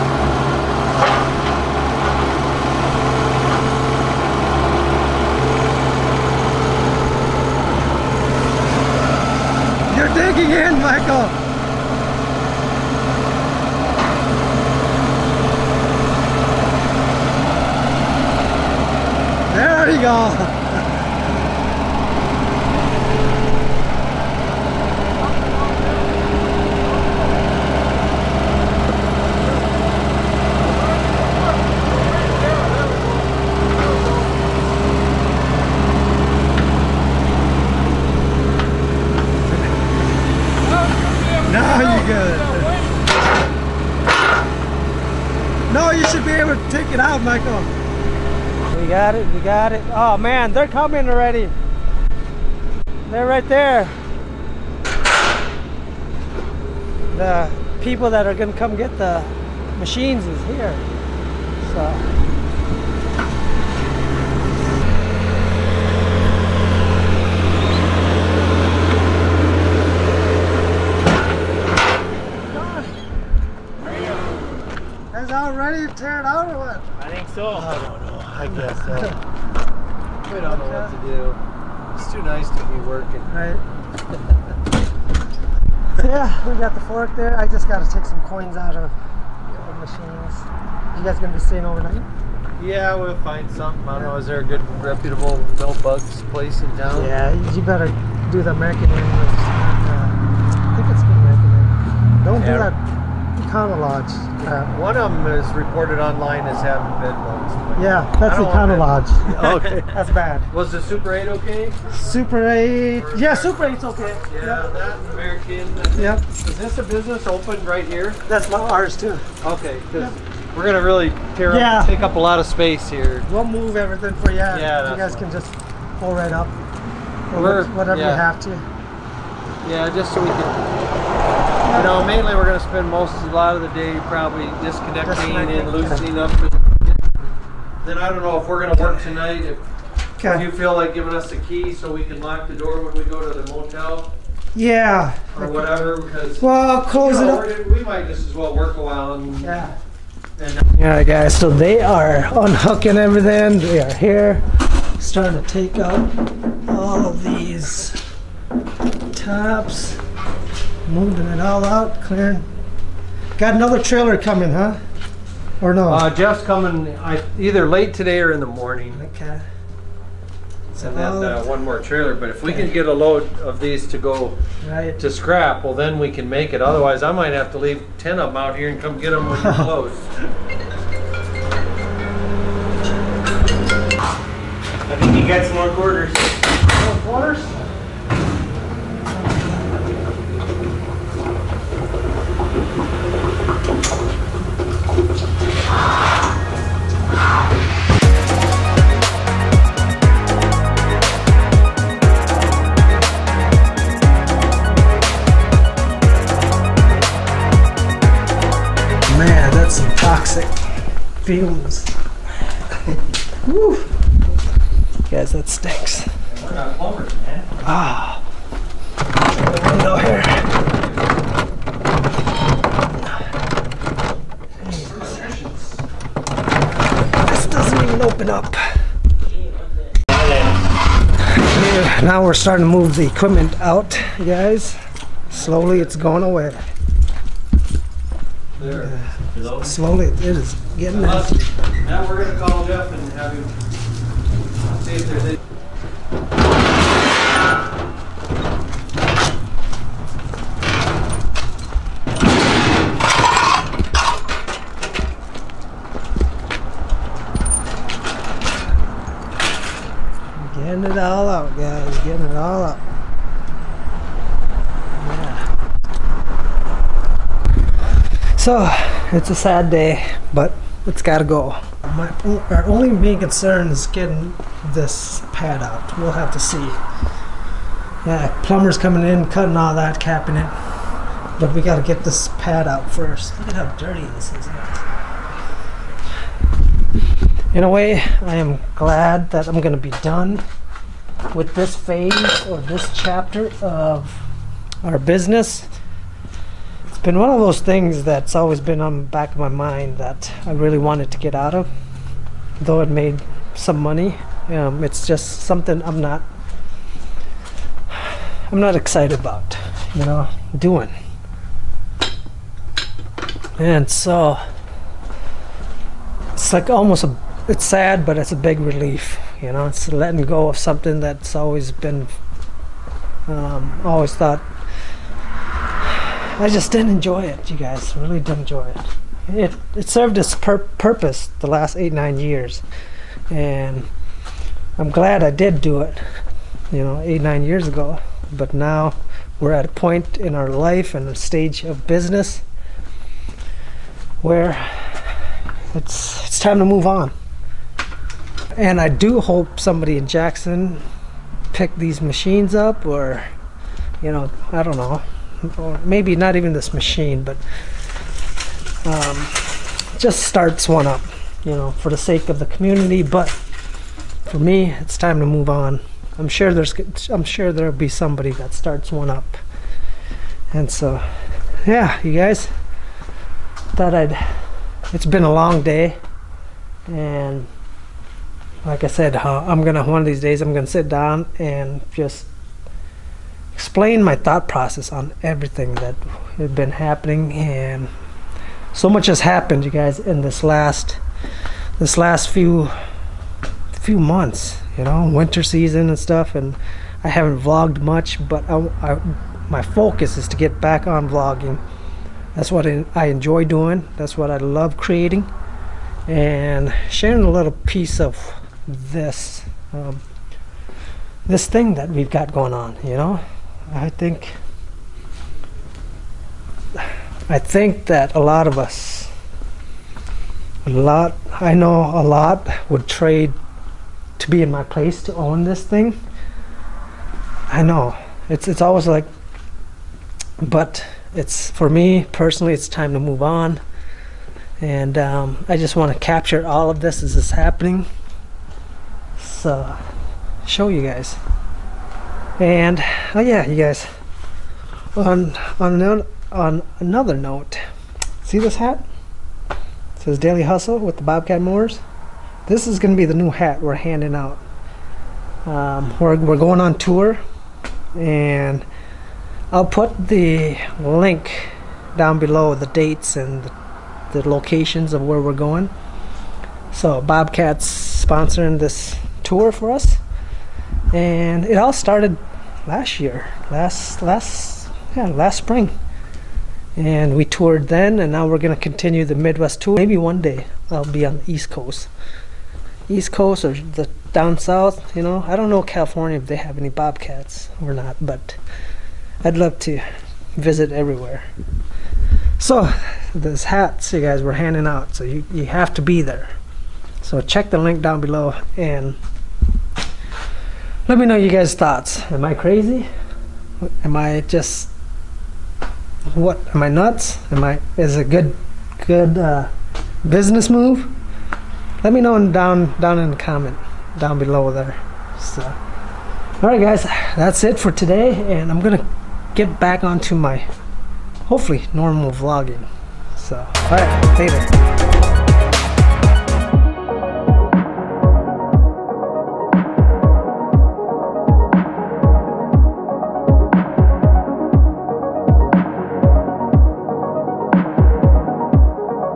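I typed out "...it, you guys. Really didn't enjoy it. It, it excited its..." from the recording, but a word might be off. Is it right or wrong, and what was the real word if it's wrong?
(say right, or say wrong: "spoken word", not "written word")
wrong: "served", not "excited".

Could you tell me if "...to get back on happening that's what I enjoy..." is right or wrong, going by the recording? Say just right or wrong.
wrong.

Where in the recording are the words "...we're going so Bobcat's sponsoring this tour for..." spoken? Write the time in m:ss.
7:45.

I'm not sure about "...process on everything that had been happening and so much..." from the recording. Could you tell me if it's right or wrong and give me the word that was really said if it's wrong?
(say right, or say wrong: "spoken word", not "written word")
right.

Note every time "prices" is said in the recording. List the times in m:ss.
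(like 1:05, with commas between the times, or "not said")
not said.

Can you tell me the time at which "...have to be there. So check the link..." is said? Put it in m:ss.
8:15.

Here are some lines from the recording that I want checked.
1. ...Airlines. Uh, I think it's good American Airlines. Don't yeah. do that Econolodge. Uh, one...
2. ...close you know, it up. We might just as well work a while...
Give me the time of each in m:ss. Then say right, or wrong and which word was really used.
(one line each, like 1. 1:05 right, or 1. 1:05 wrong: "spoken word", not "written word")
1. 1:38 right
2. 2:26 right.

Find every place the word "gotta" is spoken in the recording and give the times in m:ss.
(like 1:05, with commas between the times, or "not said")
4:31, 4:41.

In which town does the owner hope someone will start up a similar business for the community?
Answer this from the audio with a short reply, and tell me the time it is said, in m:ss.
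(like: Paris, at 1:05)
Jackson, at 5:50.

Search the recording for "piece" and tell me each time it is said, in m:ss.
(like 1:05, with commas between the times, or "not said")
6:47.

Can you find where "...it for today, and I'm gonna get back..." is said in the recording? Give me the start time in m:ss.
8:37.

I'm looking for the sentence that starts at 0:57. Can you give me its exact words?
The people that are gonna come get the machines is here.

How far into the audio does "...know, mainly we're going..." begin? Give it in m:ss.
2:11.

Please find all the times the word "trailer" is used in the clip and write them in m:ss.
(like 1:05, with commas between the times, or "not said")
2:43, 2:51.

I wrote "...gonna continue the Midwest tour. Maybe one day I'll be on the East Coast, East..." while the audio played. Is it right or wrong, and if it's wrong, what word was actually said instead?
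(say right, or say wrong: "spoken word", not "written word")
right.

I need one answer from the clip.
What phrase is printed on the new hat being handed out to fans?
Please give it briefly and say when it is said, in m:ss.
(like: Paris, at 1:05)
daily hustle, at 7:30.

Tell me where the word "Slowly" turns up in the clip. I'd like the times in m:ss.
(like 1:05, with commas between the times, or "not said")
3:55, 3:59.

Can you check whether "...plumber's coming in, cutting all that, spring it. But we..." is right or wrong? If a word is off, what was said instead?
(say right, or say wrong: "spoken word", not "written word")
wrong: "capping", not "spring".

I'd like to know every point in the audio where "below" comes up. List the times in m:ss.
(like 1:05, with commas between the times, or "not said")
7:42, 8:18, 8:34.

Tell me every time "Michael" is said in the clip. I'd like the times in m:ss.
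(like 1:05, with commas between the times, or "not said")
0:10, 0:47.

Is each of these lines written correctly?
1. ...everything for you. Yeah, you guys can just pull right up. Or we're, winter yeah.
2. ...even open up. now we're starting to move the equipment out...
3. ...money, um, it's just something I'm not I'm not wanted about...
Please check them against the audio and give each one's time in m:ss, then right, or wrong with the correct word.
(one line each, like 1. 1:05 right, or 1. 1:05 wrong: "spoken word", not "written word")
1. 2:03 wrong: "whatever", not "winter"
2. 3:47 right
3. 5:03 wrong: "excited", not "wanted".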